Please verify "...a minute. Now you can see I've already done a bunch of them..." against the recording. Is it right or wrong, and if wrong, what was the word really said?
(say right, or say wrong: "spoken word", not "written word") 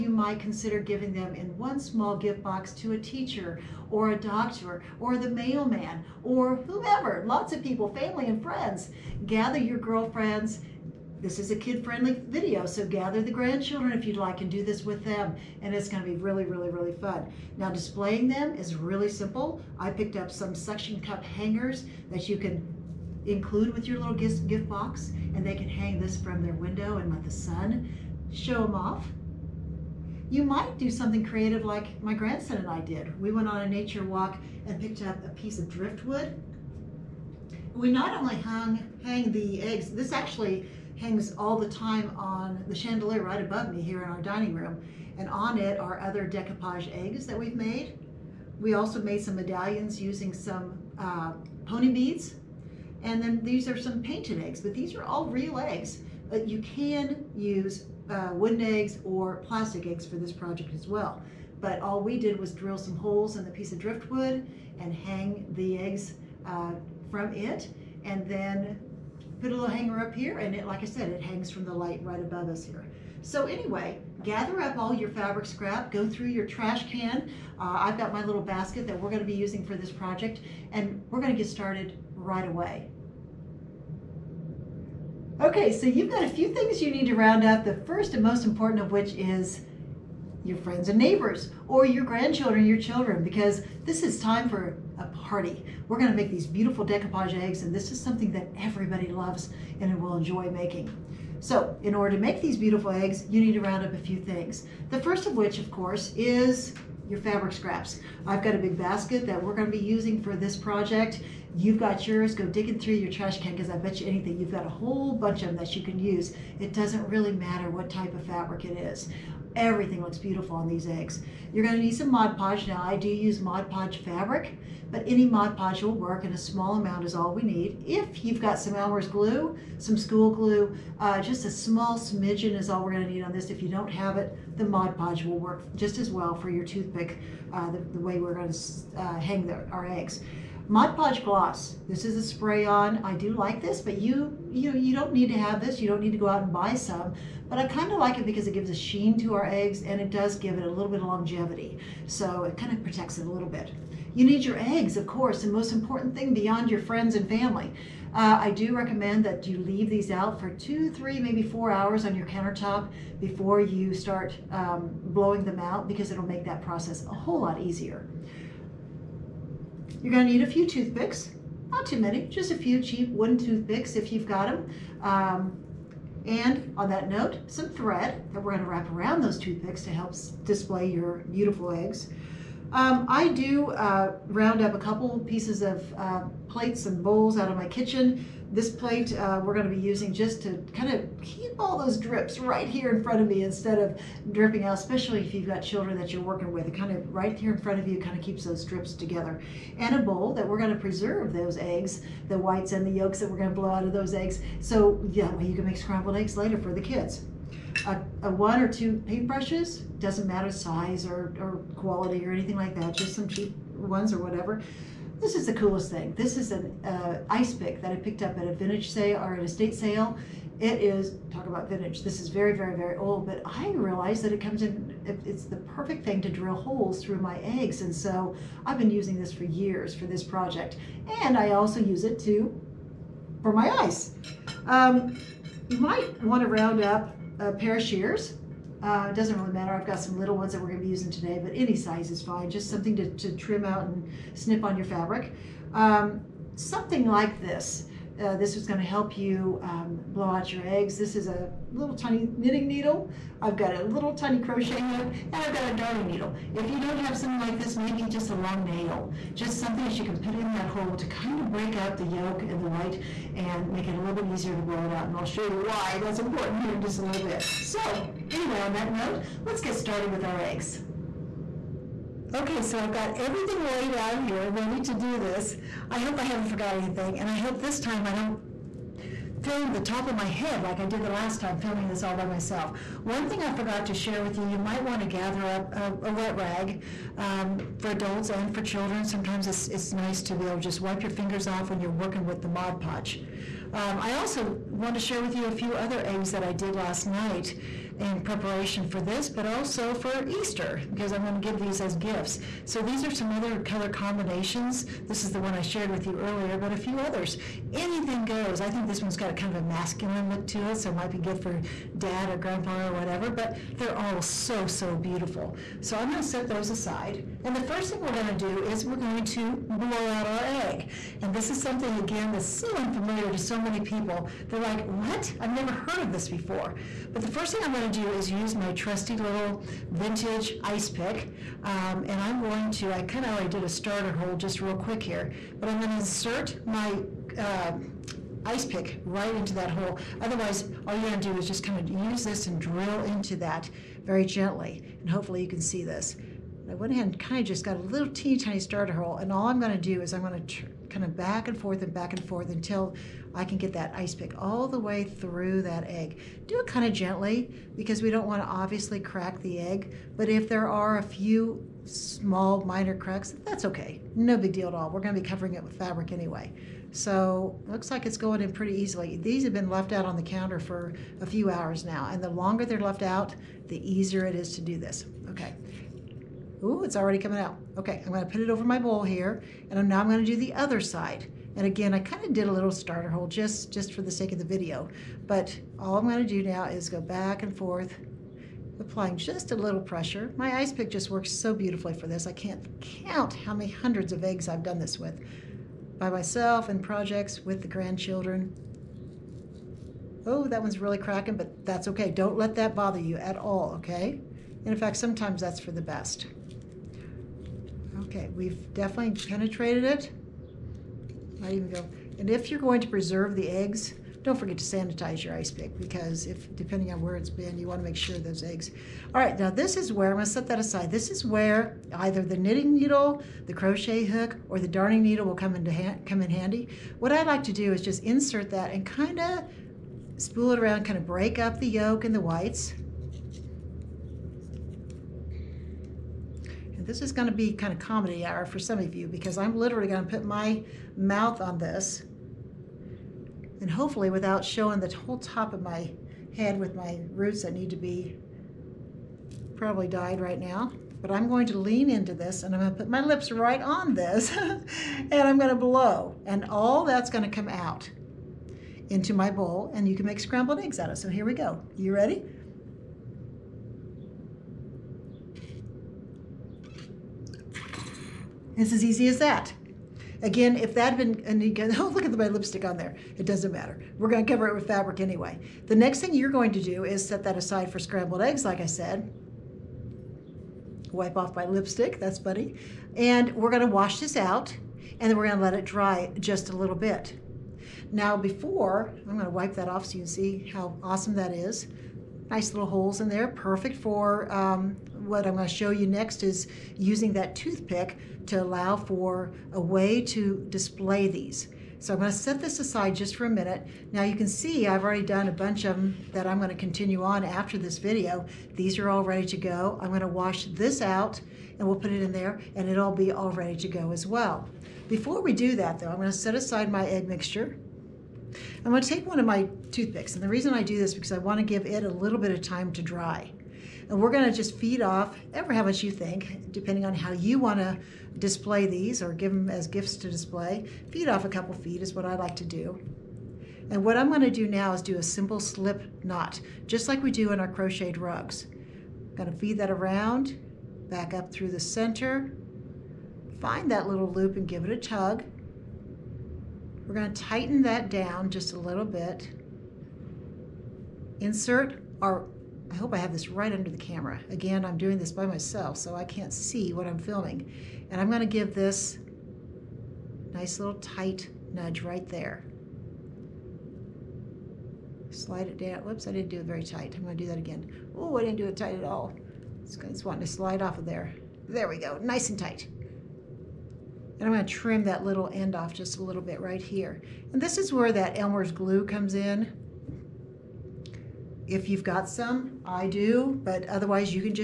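right.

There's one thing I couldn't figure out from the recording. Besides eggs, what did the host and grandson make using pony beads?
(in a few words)
medallions.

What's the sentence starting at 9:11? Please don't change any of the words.
Insert our I hope I have this right under the camera.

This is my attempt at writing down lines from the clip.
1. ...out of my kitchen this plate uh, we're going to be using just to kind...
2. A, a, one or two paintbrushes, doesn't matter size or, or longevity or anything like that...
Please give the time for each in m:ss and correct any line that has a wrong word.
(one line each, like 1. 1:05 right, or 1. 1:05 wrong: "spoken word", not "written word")
1. 3:07 right
2. 3:27 wrong: "quality", not "longevity".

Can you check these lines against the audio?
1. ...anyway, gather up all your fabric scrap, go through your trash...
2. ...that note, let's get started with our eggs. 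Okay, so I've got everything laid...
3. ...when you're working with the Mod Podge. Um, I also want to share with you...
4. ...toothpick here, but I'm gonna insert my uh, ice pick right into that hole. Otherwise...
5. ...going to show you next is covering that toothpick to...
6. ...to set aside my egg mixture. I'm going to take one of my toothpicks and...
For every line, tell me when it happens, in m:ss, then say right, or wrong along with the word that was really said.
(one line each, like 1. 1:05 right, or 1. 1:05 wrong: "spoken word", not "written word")
1. 1:13 right
2. 4:28 right
3. 4:51 right
4. 5:34 wrong: "quick", not "toothpick"
5. 8:15 wrong: "using", not "covering"
6. 8:36 right.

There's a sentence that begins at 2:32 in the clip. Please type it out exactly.
So it kind of protects it a little bit.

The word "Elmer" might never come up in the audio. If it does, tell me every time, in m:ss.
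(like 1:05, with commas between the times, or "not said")
2:08, 9:38.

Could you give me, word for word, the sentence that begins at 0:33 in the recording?
We went on a nature walk and picked up a piece of driftwood.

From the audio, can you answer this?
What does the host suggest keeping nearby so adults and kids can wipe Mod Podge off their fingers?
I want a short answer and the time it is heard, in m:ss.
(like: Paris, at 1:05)
wet rag, at 4:46.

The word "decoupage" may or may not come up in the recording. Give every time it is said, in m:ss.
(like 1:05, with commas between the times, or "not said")
0:46, 1:36.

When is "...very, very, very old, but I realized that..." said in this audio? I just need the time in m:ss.
3:42.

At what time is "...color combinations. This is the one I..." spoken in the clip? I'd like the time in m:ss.
5:03.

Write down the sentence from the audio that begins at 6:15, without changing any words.
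Okay, Ooh, it's already coming out.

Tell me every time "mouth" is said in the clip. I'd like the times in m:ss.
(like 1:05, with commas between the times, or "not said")
7:20.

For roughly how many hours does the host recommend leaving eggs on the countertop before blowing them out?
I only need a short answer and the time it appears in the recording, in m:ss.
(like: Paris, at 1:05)
2 to 4 hours, at 2:40.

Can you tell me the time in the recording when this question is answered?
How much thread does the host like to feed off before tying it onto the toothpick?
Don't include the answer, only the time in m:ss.
8:51.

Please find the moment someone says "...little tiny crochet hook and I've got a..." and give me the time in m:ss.
4:13.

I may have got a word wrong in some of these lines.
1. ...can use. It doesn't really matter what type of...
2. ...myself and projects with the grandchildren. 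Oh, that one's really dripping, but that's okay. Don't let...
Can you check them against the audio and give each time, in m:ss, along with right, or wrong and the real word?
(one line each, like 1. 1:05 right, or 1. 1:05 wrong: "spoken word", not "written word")
1. 1:55 right
2. 6:36 wrong: "cracking", not "dripping".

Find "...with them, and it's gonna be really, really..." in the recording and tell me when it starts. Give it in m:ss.
0:14.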